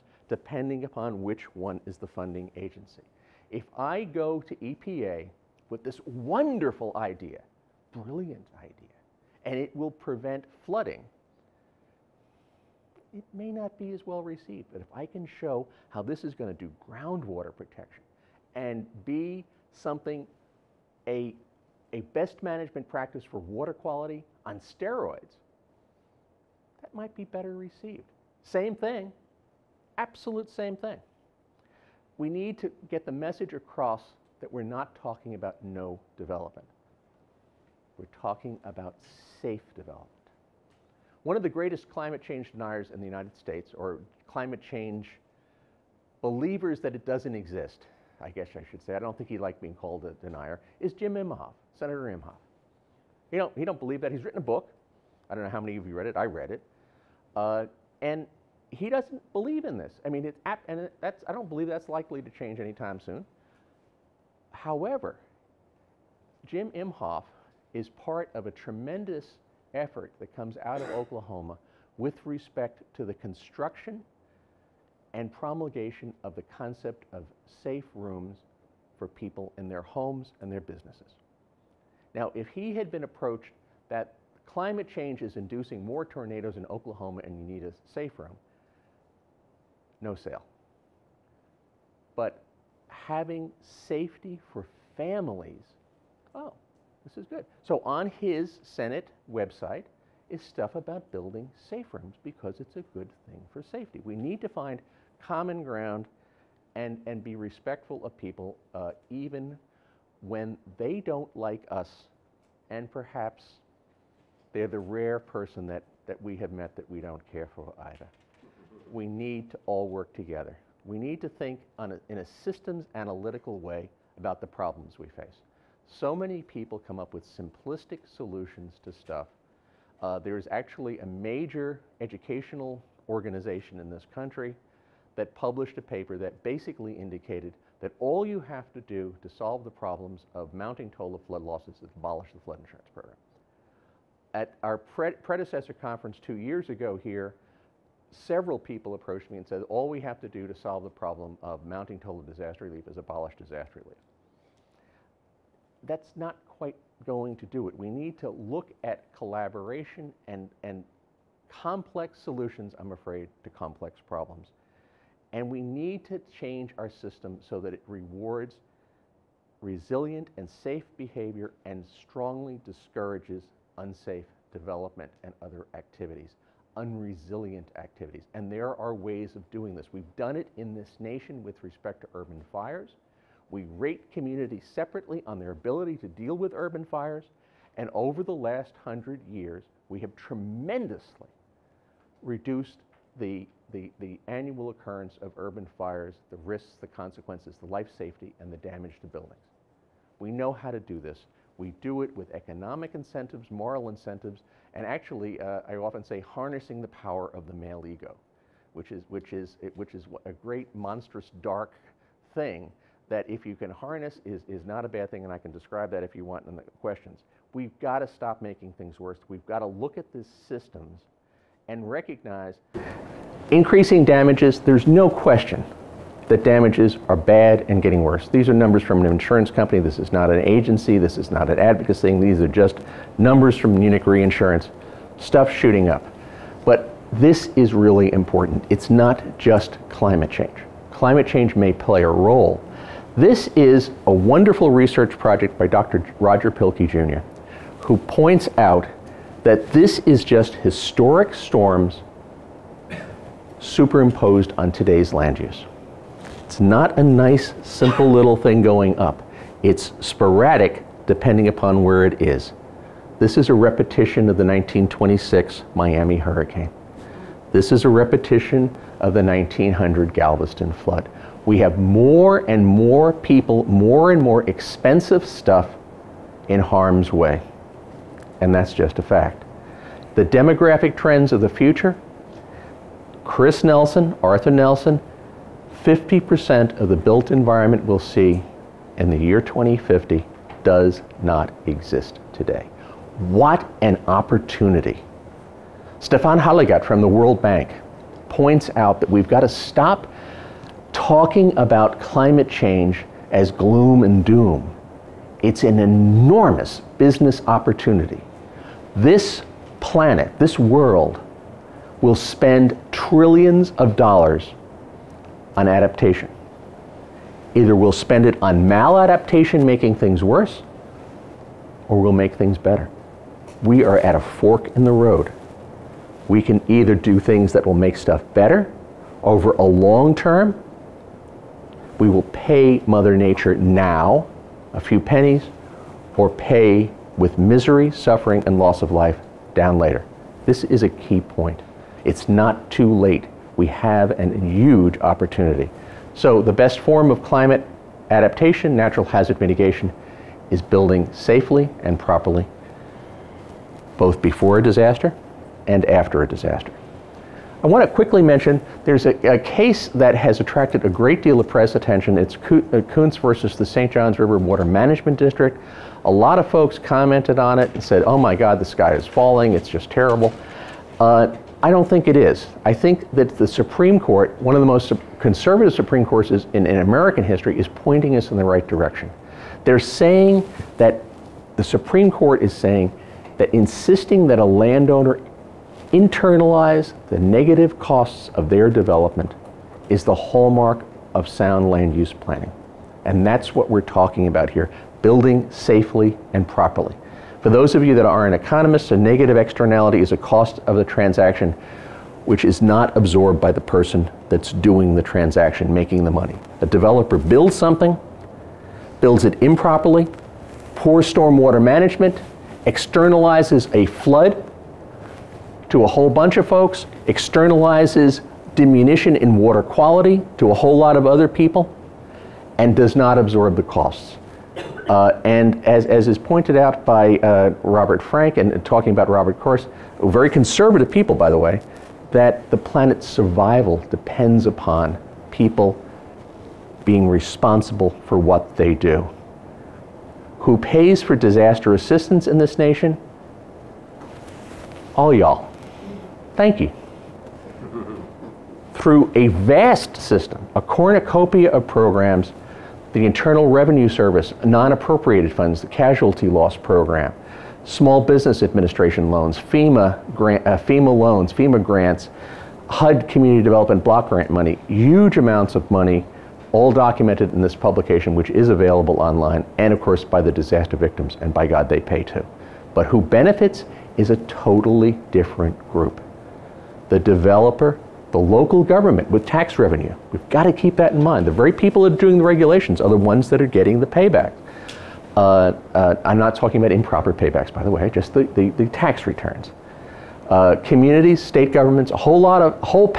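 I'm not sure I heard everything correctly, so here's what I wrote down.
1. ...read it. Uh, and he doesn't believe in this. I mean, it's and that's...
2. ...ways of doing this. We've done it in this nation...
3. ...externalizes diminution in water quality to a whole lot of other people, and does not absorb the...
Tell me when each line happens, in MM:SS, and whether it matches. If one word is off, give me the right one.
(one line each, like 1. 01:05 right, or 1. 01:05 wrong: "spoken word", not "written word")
1. 00:56 right
2. 02:58 right
3. 06:57 right.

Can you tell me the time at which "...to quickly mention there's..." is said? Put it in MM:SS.
05:57.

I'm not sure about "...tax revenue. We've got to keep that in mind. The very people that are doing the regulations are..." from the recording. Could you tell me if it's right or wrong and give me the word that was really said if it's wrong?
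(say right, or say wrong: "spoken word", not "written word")
right.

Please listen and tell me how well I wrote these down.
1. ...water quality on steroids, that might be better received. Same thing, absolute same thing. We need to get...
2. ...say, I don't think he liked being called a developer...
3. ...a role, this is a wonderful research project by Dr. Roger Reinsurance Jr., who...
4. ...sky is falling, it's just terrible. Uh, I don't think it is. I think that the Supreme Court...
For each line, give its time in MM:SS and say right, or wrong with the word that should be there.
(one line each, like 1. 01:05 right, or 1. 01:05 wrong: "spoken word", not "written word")
1. 00:23 right
2. 00:48 wrong: "denier", not "developer"
3. 04:02 wrong: "Pielke", not "Reinsurance"
4. 06:08 right.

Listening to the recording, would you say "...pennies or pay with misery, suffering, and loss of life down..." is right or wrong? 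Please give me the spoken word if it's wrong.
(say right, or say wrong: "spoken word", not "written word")
right.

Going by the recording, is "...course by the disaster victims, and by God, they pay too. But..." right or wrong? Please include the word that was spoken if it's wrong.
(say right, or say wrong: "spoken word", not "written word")
right.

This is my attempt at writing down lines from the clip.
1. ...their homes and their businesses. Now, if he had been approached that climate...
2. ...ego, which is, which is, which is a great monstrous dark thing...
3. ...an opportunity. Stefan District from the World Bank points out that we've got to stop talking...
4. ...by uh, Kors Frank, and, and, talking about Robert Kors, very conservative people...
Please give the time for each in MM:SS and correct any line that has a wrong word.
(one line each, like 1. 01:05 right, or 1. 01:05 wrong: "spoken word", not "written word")
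1. 01:19 right
2. 03:27 right
3. 04:53 wrong: "Hallegatte", not "District"
4. 07:06 wrong: "Robert", not "Kors".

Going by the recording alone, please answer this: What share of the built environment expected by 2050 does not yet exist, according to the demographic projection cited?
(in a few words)
50%.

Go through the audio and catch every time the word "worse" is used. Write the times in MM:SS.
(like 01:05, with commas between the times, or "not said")
03:38, 03:48, 05:20.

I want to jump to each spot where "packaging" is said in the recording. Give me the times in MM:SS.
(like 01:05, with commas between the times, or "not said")
not said.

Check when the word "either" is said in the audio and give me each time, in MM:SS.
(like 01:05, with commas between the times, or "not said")
01:57, 05:17, 05:26.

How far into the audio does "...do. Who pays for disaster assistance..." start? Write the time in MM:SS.
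07:18.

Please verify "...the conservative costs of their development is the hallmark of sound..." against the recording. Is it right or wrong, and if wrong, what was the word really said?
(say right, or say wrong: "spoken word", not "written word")
wrong: "negative", not "conservative".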